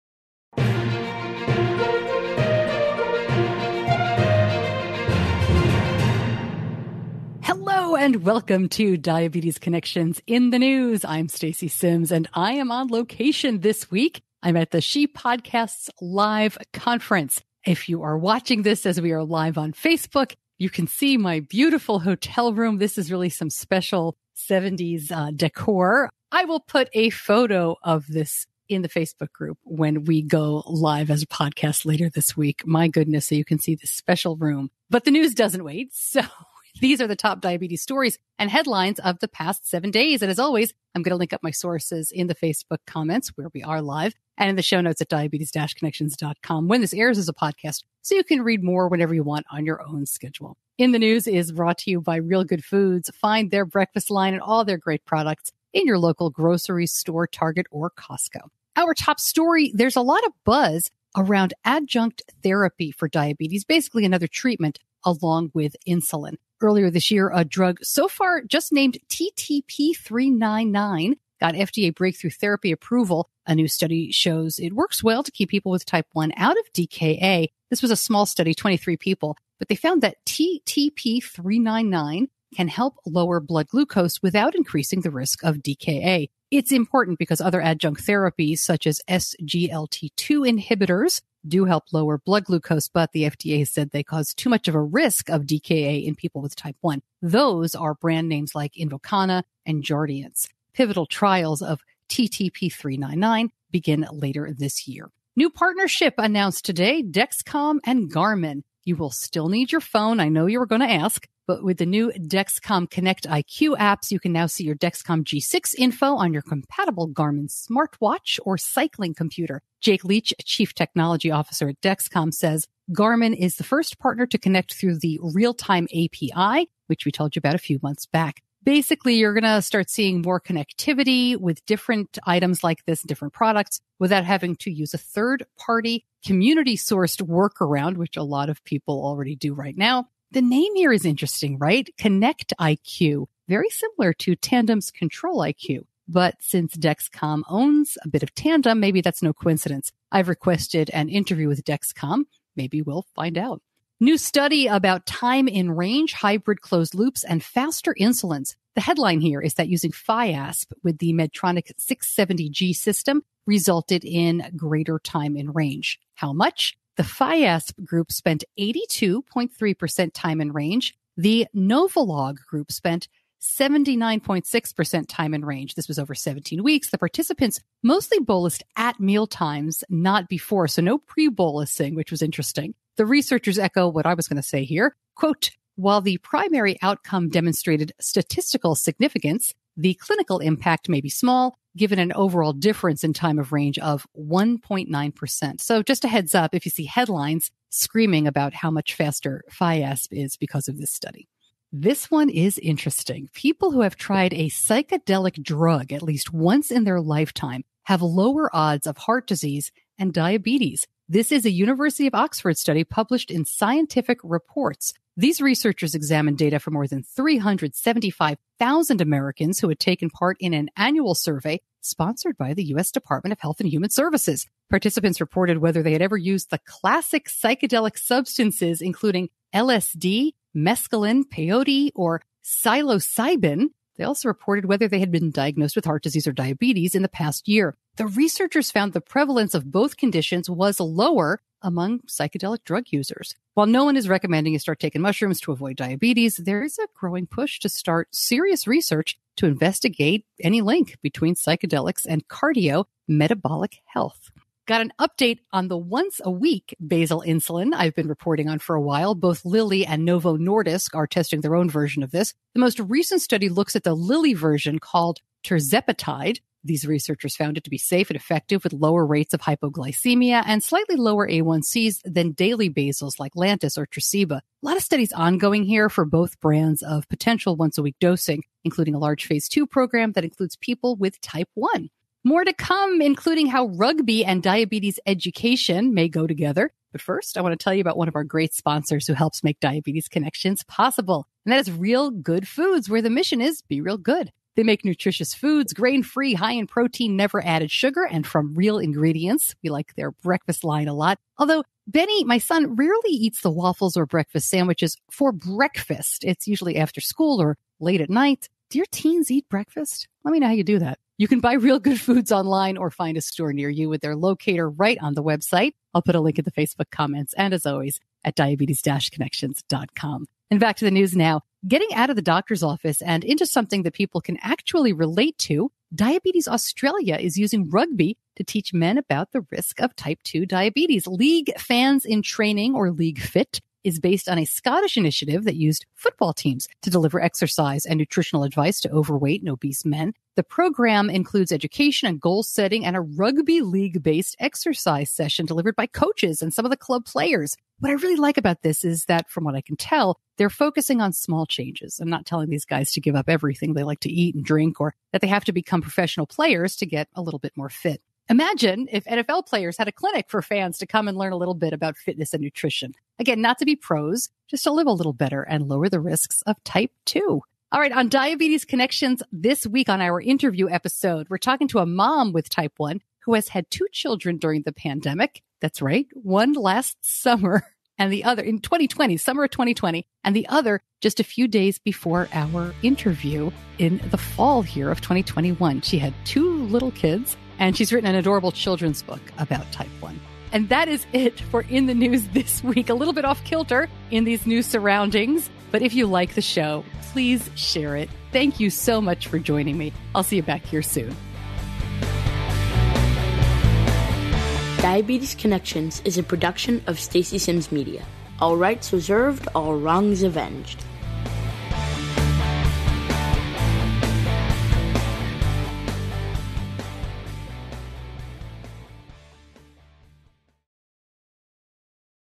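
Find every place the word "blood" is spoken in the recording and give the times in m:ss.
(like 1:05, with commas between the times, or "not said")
1:23, 1:32.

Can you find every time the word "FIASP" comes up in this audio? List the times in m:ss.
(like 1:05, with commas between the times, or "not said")
2:39, 2:47, 3:19.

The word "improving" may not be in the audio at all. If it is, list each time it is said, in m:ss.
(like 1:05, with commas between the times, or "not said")
not said.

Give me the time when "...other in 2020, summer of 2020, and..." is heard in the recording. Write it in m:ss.
6:18.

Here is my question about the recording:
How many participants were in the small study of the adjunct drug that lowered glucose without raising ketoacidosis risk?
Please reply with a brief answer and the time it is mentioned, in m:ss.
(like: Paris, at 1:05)
23, at 1:18.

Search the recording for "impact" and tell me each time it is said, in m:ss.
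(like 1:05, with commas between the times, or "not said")
3:10.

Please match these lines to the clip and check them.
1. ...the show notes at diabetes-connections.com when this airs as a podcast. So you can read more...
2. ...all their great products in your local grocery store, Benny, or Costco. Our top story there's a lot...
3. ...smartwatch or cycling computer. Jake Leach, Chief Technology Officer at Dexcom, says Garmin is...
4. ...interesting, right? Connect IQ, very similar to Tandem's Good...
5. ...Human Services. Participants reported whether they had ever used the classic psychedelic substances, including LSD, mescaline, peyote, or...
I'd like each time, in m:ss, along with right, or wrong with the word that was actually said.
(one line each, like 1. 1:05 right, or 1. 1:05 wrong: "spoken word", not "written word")
1. 0:44 right
2. 0:54 wrong: "Target", not "Benny"
3. 1:57 right
4. 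2:21 wrong: "Control", not "Good"
5. 3:43 right.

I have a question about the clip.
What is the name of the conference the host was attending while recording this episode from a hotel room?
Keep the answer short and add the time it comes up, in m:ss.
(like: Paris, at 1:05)
She Podcasts Live, at 0:14.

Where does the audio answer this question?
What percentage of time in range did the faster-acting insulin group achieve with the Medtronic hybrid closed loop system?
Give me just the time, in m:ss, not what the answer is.
2:48.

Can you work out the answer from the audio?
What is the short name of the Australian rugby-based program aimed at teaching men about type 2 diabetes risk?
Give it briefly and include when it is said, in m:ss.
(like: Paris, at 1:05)
League Fit, at 5:32.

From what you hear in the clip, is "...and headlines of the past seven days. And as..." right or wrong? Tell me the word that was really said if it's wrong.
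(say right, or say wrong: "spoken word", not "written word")
right.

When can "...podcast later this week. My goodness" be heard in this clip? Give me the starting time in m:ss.
0:31.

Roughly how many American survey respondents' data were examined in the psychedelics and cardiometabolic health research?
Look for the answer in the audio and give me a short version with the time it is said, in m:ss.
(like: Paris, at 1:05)
375,000, at 3:37.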